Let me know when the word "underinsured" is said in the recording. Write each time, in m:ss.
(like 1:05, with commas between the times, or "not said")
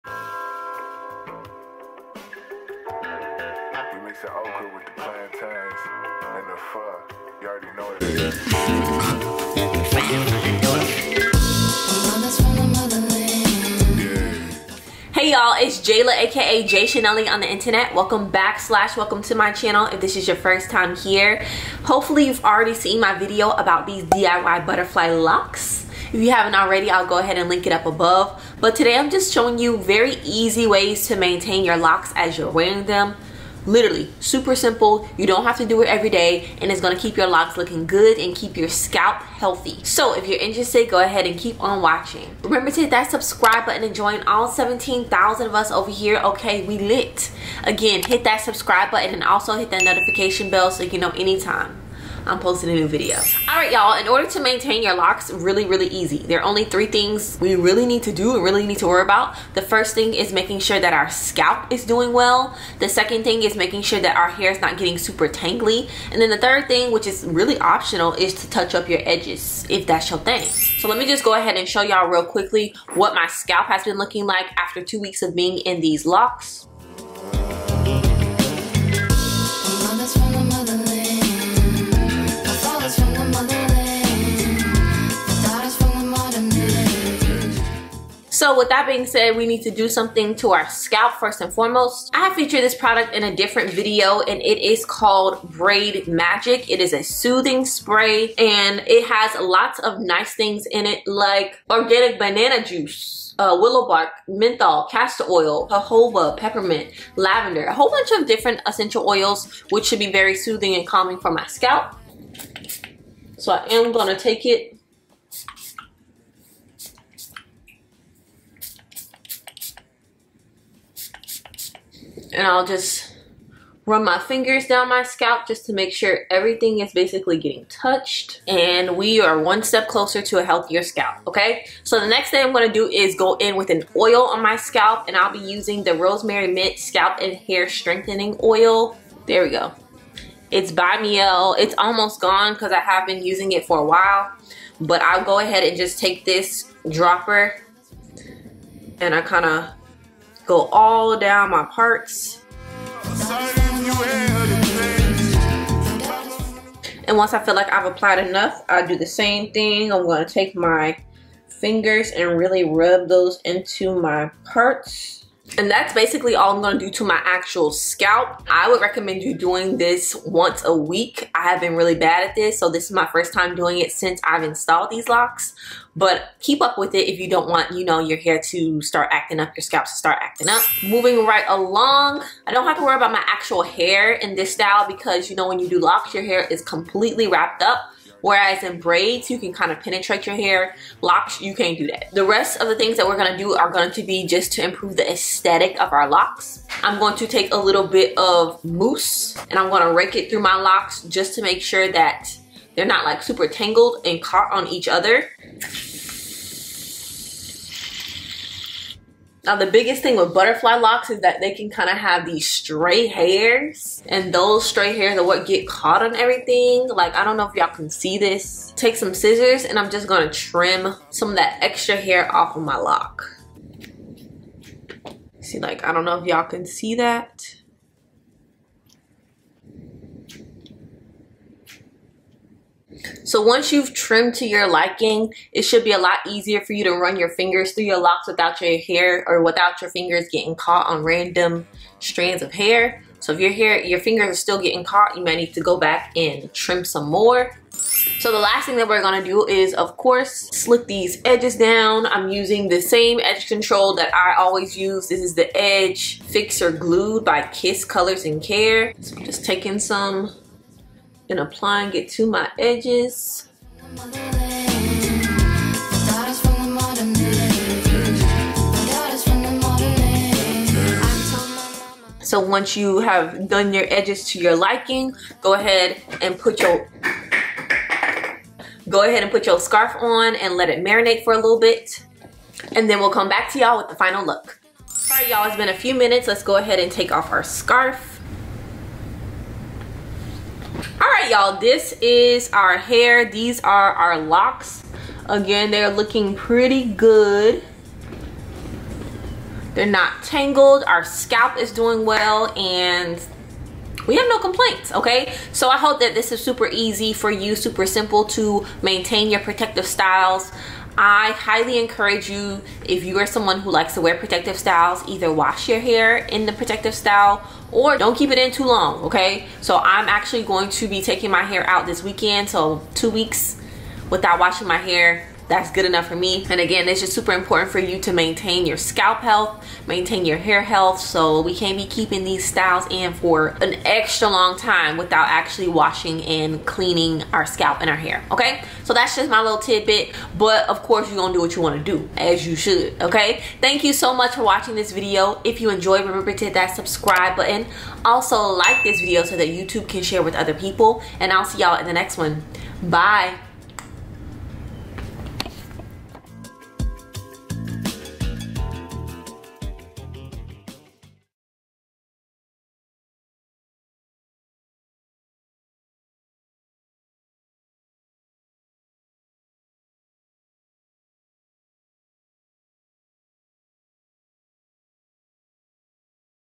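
not said.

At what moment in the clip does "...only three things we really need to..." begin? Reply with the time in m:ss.
0:56.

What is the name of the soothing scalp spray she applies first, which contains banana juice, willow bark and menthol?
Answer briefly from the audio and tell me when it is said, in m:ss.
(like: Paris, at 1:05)
Braid Magic, at 1:35.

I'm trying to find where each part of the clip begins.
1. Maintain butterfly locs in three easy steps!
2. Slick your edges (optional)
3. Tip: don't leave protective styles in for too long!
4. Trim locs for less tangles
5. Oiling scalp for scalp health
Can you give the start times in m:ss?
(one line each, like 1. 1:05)
1. 0:53
2. 4:08
3. 4:45
4. 3:01
5. 1:11.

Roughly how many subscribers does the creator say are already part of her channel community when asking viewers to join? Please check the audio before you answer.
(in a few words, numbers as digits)
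17,000.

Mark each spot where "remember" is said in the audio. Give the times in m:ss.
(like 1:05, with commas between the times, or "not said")
0:42, 5:46.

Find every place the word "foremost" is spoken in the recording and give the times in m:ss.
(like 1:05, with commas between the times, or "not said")
1:31.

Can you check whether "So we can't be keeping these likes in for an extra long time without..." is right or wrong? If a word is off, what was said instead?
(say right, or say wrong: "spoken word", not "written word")
wrong: "styles", not "likes".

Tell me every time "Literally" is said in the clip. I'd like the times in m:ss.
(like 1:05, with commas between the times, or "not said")
0:33.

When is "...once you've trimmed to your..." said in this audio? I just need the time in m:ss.
3:53.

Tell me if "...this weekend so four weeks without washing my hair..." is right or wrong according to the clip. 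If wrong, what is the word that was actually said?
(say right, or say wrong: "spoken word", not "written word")
wrong: "two", not "four".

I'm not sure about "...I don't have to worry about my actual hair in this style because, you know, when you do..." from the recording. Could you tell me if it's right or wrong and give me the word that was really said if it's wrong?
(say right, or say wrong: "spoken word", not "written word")
right.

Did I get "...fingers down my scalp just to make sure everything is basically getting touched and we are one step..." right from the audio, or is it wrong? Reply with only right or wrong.
right.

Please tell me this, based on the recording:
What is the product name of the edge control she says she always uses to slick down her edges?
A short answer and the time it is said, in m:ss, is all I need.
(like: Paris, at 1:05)
Edge Fixer Glued, at 4:15.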